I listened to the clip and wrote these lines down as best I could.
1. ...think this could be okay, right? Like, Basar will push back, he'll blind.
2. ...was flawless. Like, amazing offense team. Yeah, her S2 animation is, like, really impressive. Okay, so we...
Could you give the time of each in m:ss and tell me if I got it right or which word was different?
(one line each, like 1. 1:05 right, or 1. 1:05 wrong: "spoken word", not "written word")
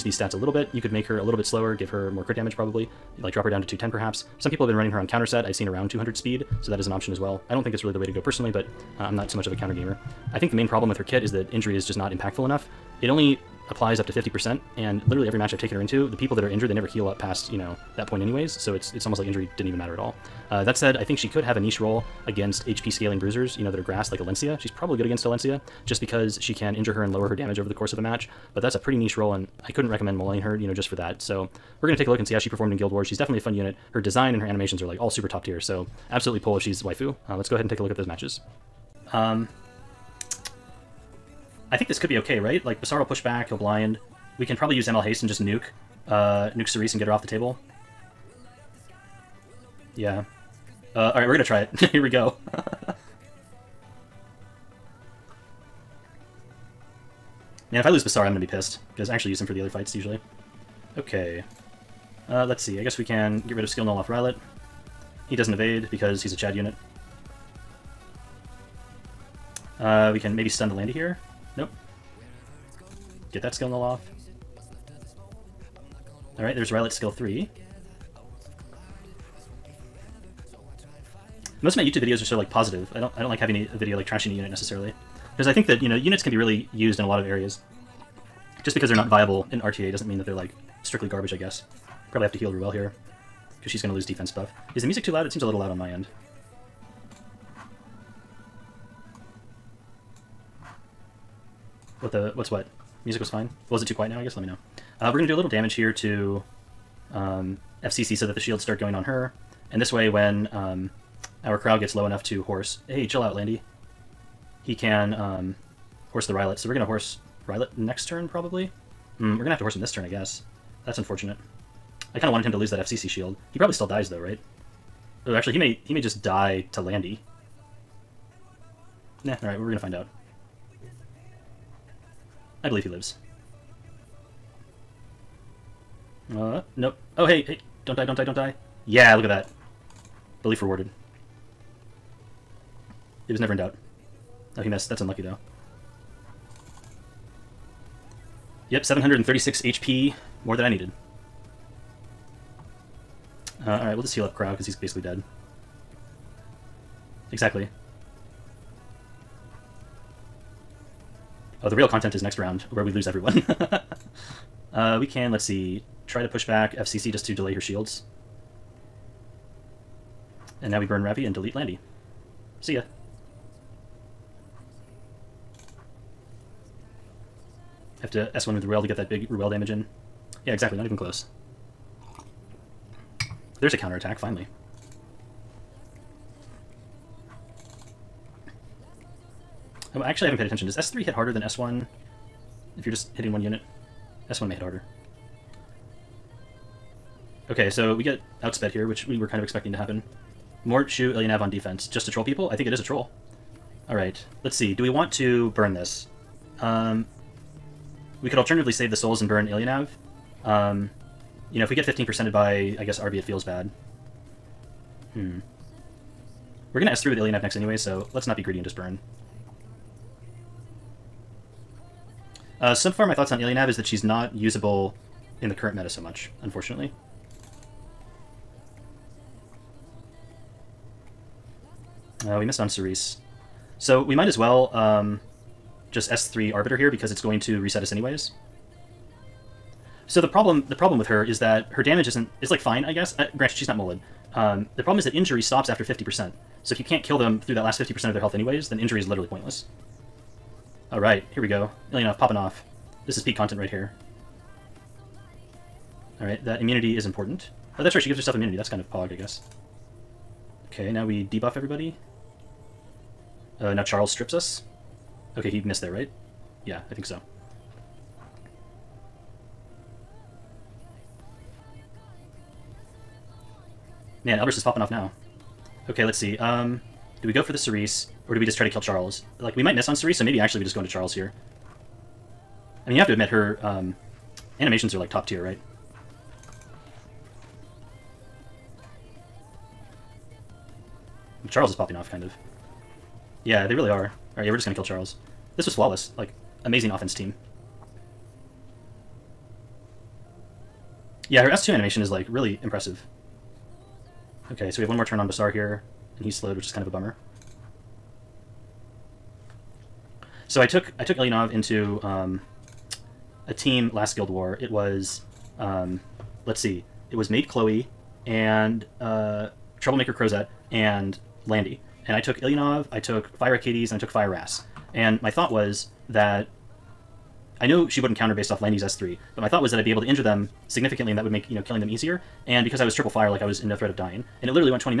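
1. 0:41 right
2. 4:55 right.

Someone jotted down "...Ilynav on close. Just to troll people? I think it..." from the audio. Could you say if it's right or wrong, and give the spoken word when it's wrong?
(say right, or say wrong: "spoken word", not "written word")
wrong: "defense", not "close".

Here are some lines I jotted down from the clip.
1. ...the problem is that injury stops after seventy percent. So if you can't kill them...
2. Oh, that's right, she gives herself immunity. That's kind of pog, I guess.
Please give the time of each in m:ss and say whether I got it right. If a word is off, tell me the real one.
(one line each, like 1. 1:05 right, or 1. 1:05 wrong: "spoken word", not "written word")
1. 4:04 wrong: "fifty", not "seventy"
2. 4:17 right.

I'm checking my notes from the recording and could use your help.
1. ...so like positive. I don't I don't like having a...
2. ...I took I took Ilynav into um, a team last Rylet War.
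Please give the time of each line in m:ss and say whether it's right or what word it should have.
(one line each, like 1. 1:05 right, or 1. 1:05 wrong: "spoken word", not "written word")
1. 1:22 right
2. 5:10 wrong: "Guild", not "Rylet".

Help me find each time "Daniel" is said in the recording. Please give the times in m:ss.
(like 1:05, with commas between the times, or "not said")
not said.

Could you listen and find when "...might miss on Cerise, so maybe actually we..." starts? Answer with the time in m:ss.
4:39.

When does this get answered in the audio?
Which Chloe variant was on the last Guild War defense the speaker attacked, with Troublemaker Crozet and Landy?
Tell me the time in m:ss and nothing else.
5:17.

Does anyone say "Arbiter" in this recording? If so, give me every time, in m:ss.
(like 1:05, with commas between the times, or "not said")
3:56.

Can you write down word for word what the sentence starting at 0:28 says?
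But that's a pretty niche role, and I couldn't recommend mulling her, you know, just for that.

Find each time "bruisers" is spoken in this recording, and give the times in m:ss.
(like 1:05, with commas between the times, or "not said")
0:23.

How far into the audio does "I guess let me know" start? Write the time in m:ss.
1:44.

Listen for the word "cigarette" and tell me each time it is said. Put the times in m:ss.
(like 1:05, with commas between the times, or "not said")
not said.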